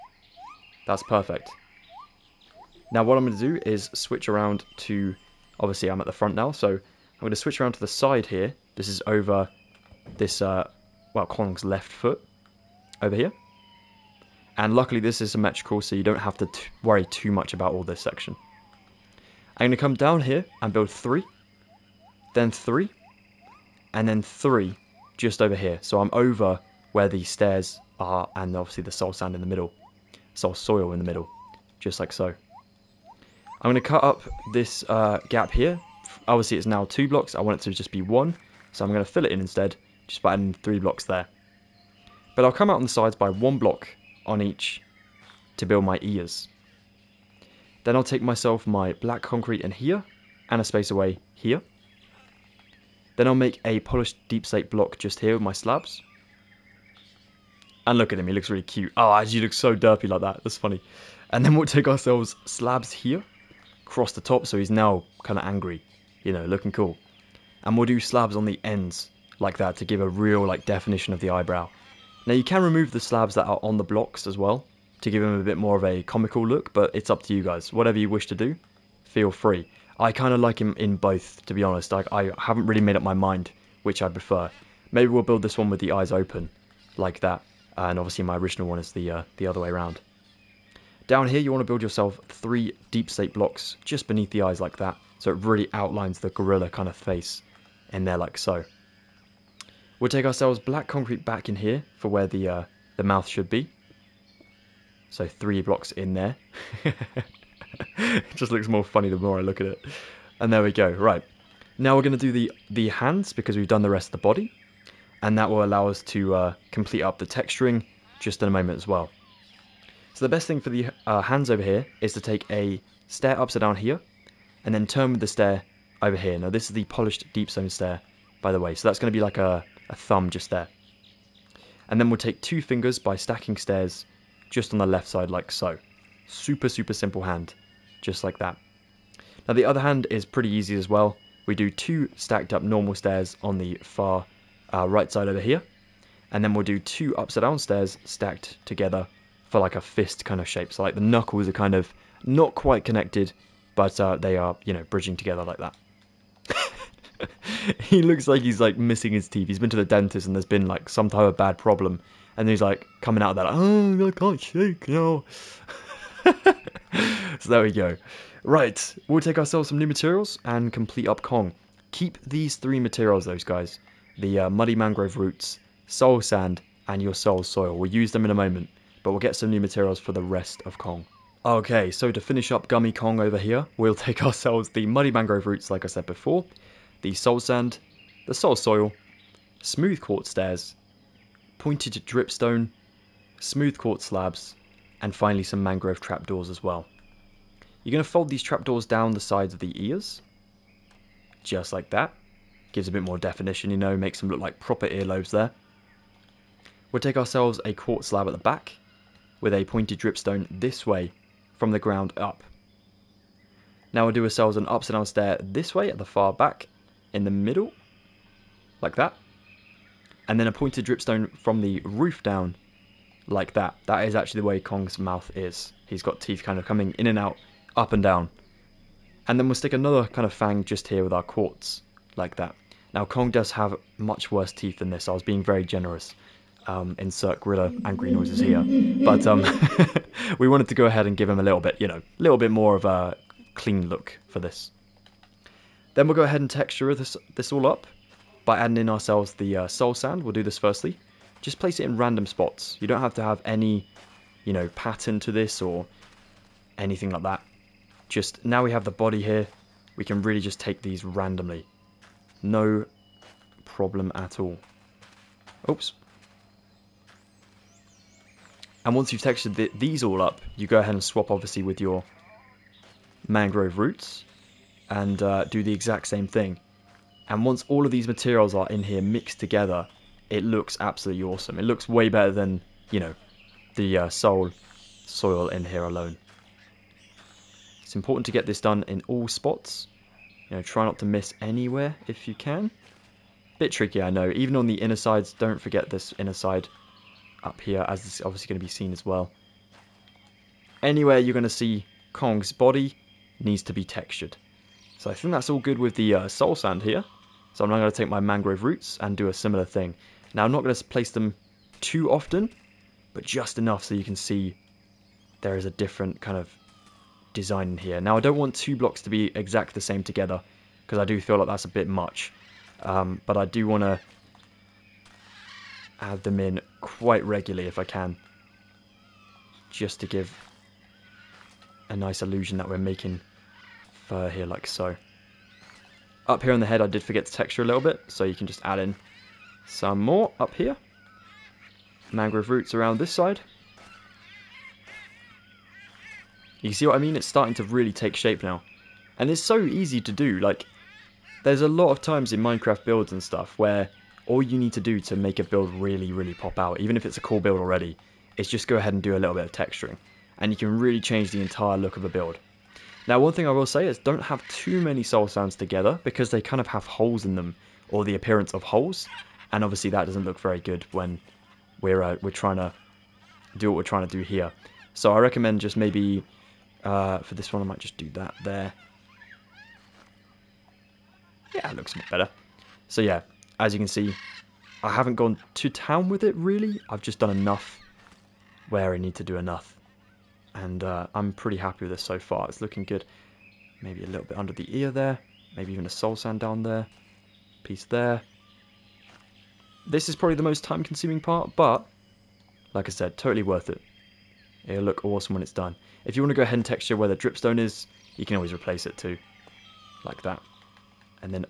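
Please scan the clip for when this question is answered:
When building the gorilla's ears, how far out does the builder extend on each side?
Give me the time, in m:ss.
0:43.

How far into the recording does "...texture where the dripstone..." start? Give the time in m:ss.
6:46.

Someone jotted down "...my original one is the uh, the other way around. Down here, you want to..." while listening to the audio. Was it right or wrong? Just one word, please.
right.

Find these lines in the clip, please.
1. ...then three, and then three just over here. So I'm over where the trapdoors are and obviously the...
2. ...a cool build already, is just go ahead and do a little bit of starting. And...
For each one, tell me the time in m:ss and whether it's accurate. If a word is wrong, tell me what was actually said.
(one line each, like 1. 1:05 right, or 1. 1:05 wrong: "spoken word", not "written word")
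1. 0:22 wrong: "stairs", not "trapdoors"
2. 5:57 wrong: "texturing", not "starting".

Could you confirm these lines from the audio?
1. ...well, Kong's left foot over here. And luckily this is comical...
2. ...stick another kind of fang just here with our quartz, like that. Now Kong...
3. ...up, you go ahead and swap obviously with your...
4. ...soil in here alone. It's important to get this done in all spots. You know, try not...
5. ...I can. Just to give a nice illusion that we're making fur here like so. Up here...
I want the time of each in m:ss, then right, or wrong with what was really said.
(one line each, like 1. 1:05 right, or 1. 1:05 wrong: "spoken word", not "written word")
1. 0:11 wrong: "symmetrical", not "comical"
2. 3:49 right
3. 4:30 right
4. 4:44 right
5. 5:27 right.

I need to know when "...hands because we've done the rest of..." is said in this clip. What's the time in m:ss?
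1:52.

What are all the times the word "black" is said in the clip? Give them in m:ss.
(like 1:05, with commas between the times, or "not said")
0:48, 1:40.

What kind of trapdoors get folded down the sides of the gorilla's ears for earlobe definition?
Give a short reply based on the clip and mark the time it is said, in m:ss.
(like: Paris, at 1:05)
Mangrove Trapdoors, at 3:15.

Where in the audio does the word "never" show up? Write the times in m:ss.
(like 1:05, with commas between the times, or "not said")
not said.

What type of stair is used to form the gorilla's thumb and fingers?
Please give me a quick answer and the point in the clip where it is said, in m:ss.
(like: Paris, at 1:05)
polished deep stone stair, at 2:06.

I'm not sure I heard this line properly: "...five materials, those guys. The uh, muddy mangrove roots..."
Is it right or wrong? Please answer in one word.
wrong.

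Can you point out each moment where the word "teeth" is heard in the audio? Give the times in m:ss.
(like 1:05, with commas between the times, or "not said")
2:39, 3:46, 3:54.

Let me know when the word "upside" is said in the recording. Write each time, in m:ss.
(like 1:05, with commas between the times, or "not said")
2:03, 2:27, 3:34.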